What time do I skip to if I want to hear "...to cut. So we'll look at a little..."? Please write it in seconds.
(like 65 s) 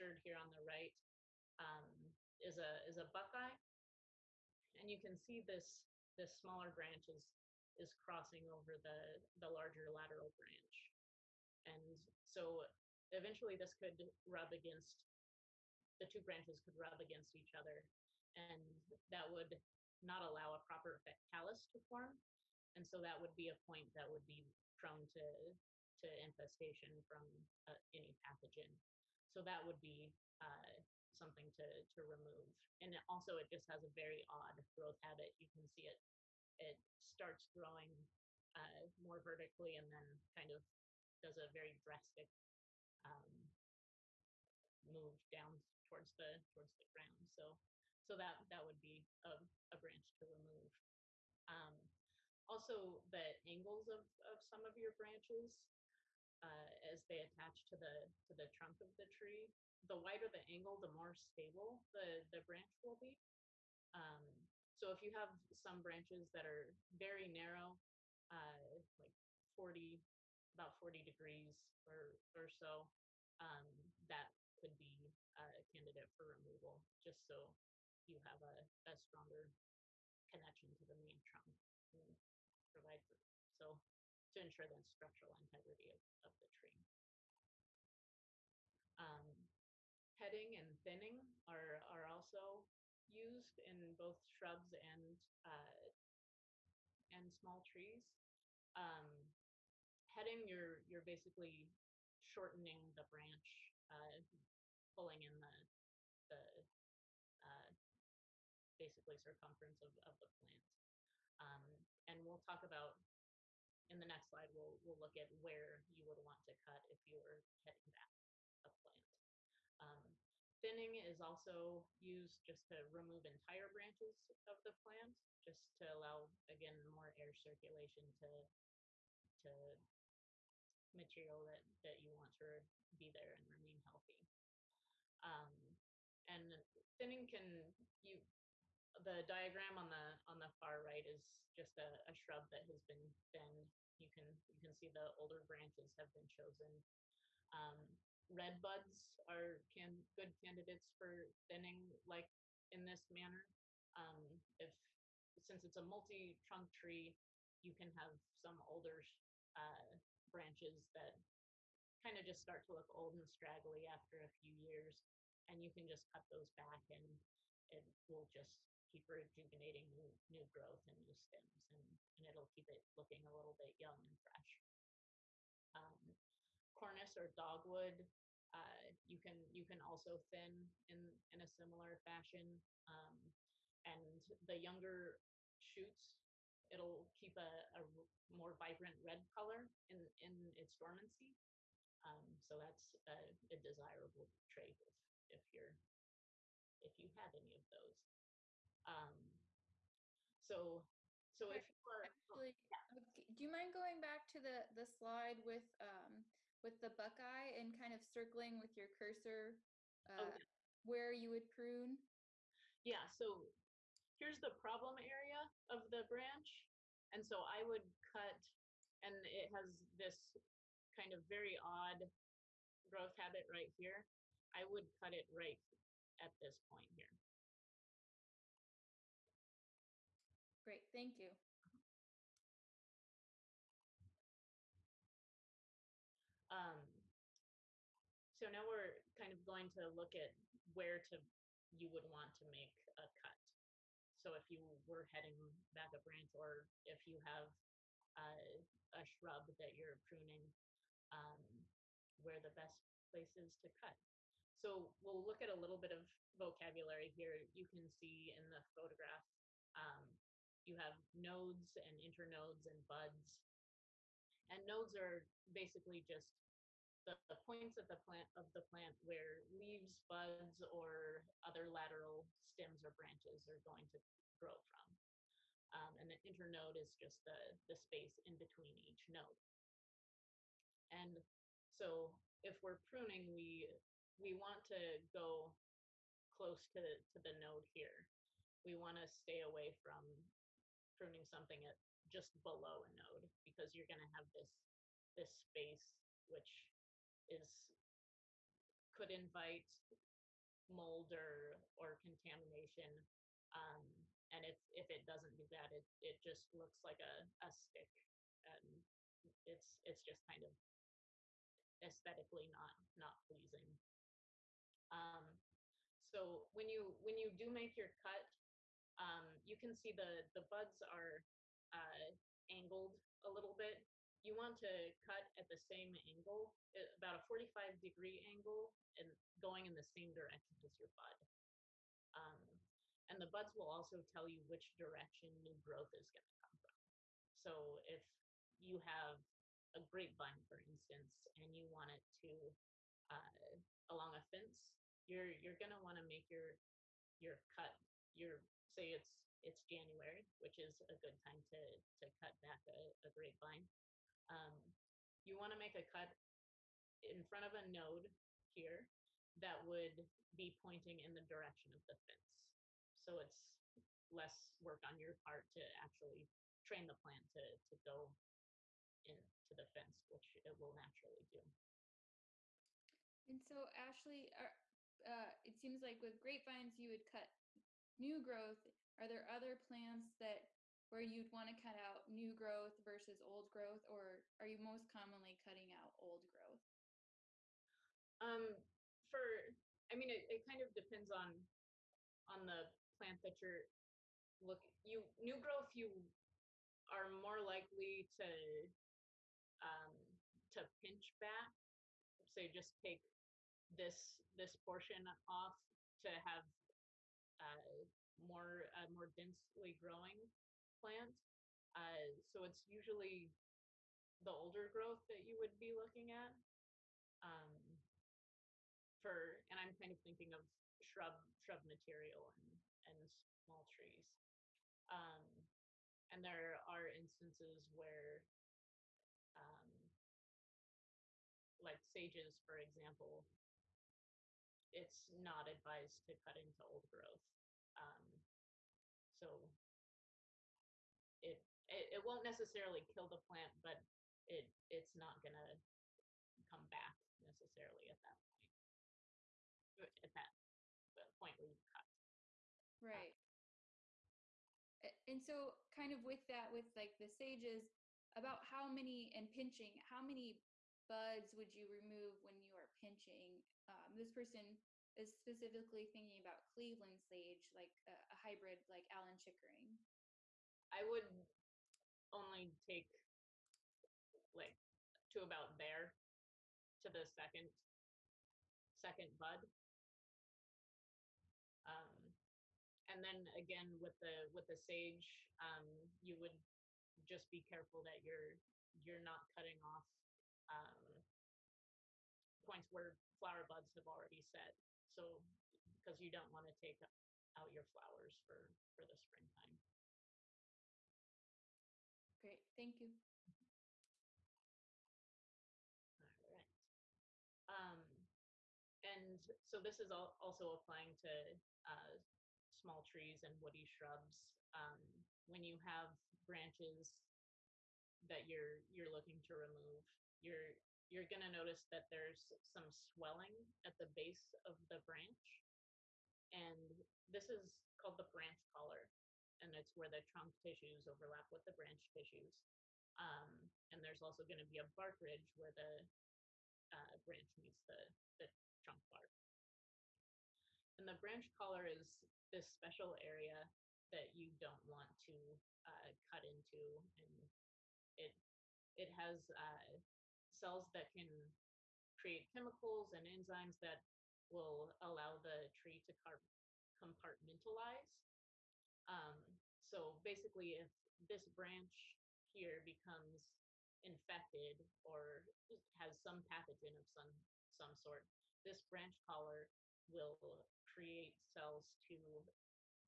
253 s.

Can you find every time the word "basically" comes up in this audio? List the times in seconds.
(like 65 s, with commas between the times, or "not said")
101 s, 108 s, 265 s, 560 s.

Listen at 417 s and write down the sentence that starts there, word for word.
Um, for and I'm kind of thinking of shrub shrub material and and small trees.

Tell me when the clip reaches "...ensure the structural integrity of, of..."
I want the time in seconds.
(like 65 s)
84 s.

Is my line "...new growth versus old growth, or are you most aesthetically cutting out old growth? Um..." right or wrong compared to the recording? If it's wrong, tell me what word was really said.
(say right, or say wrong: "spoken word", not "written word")
wrong: "commonly", not "aesthetically".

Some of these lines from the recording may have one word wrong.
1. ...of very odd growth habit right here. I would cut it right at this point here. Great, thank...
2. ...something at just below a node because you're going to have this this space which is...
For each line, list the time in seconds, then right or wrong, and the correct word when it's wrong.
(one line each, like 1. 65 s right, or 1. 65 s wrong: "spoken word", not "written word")
1. 221 s right
2. 291 s right.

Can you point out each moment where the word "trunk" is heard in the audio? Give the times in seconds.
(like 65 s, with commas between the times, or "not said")
58 s, 81 s, 155 s, 530 s, 538 s.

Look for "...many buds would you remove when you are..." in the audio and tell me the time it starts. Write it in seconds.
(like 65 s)
460 s.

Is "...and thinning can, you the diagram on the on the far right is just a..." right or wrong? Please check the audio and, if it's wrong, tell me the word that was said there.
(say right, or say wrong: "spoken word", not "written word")
right.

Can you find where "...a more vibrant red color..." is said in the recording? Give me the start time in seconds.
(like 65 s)
187 s.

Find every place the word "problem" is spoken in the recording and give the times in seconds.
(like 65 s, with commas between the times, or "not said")
214 s.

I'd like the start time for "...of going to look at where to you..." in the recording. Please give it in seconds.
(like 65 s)
239 s.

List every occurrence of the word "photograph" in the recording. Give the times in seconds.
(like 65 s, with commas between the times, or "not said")
258 s.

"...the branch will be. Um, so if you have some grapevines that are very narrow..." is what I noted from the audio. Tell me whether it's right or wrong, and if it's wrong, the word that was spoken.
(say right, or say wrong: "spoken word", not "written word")
wrong: "branches", not "grapevines".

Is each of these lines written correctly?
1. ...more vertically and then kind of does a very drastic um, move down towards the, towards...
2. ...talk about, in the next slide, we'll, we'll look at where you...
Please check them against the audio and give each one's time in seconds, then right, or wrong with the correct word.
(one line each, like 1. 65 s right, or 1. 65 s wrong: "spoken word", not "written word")
1. 38 s right
2. 112 s right.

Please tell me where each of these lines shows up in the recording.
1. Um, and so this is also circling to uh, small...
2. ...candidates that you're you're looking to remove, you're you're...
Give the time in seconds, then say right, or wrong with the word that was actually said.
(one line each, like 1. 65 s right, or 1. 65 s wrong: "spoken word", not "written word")
1. 507 s wrong: "applying", not "circling"
2. 516 s wrong: "branches", not "candidates".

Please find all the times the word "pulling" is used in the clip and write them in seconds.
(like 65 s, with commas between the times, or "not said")
104 s.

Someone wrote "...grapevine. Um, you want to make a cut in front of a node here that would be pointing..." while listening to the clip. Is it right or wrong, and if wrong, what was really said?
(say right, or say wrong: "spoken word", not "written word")
right.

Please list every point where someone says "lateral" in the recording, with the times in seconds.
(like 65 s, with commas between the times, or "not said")
9 s, 271 s.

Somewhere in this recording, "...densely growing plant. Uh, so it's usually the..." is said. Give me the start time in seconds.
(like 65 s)
409 s.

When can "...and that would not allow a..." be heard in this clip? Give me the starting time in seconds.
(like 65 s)
18 s.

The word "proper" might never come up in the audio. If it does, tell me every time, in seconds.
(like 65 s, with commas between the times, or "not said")
20 s.